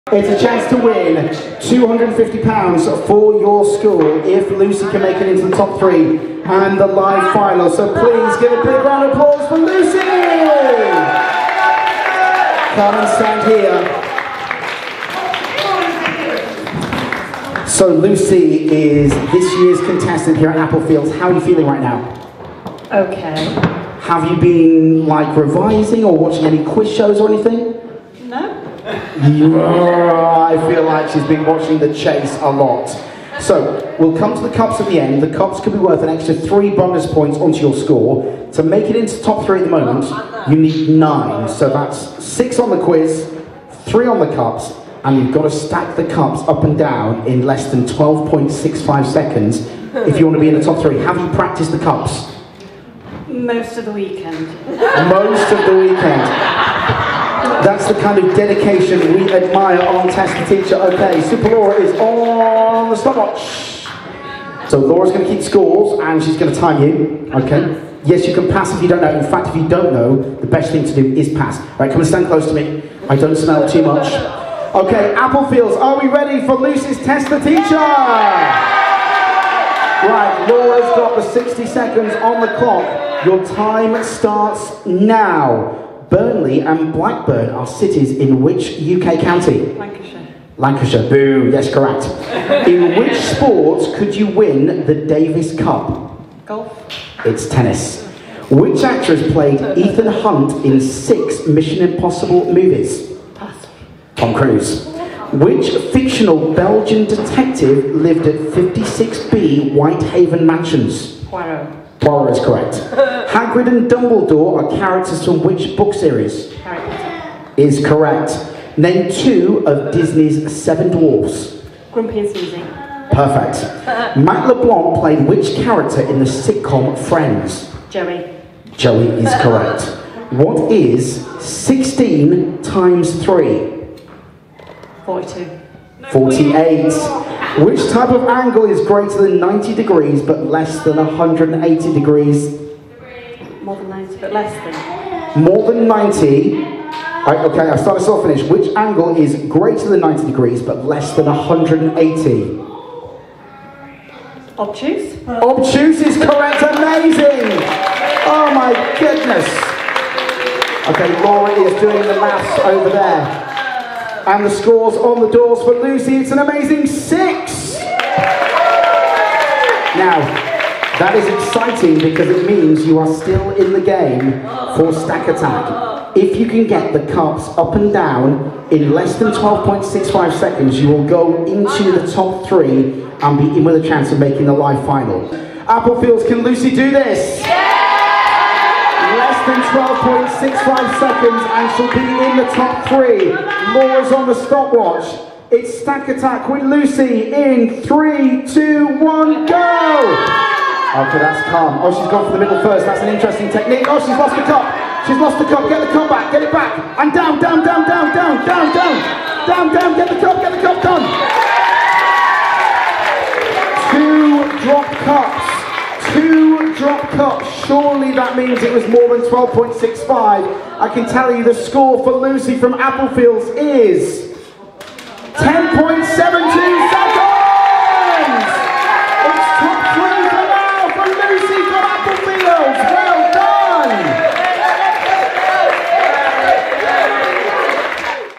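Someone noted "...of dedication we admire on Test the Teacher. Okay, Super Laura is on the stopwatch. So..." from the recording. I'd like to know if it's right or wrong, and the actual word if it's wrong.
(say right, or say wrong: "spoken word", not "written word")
right.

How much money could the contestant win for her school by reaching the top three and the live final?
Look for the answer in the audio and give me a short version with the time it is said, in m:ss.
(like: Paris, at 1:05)
£250, at 0:01.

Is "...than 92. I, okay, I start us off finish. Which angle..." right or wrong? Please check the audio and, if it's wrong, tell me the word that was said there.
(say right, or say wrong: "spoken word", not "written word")
wrong: "90", not "92".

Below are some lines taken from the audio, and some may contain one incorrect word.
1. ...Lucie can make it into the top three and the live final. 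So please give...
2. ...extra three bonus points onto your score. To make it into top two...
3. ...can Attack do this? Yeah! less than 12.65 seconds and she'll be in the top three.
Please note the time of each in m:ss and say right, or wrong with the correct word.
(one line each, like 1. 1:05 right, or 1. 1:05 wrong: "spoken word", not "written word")
1. 0:04 right
2. 0:36 wrong: "three", not "two"
3. 3:06 wrong: "Lucie", not "Attack".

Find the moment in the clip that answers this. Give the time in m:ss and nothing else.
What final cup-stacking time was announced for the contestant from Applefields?
3:45.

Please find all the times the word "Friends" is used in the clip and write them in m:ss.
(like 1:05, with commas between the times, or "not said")
2:06.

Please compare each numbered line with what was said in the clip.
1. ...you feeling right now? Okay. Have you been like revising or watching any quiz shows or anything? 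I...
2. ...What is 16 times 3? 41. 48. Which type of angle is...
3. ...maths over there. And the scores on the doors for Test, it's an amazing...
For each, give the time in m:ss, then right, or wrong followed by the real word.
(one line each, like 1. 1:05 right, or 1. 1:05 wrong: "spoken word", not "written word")
1. 0:21 right
2. 2:10 wrong: "42", not "41"
3. 2:42 wrong: "Lucie", not "Test".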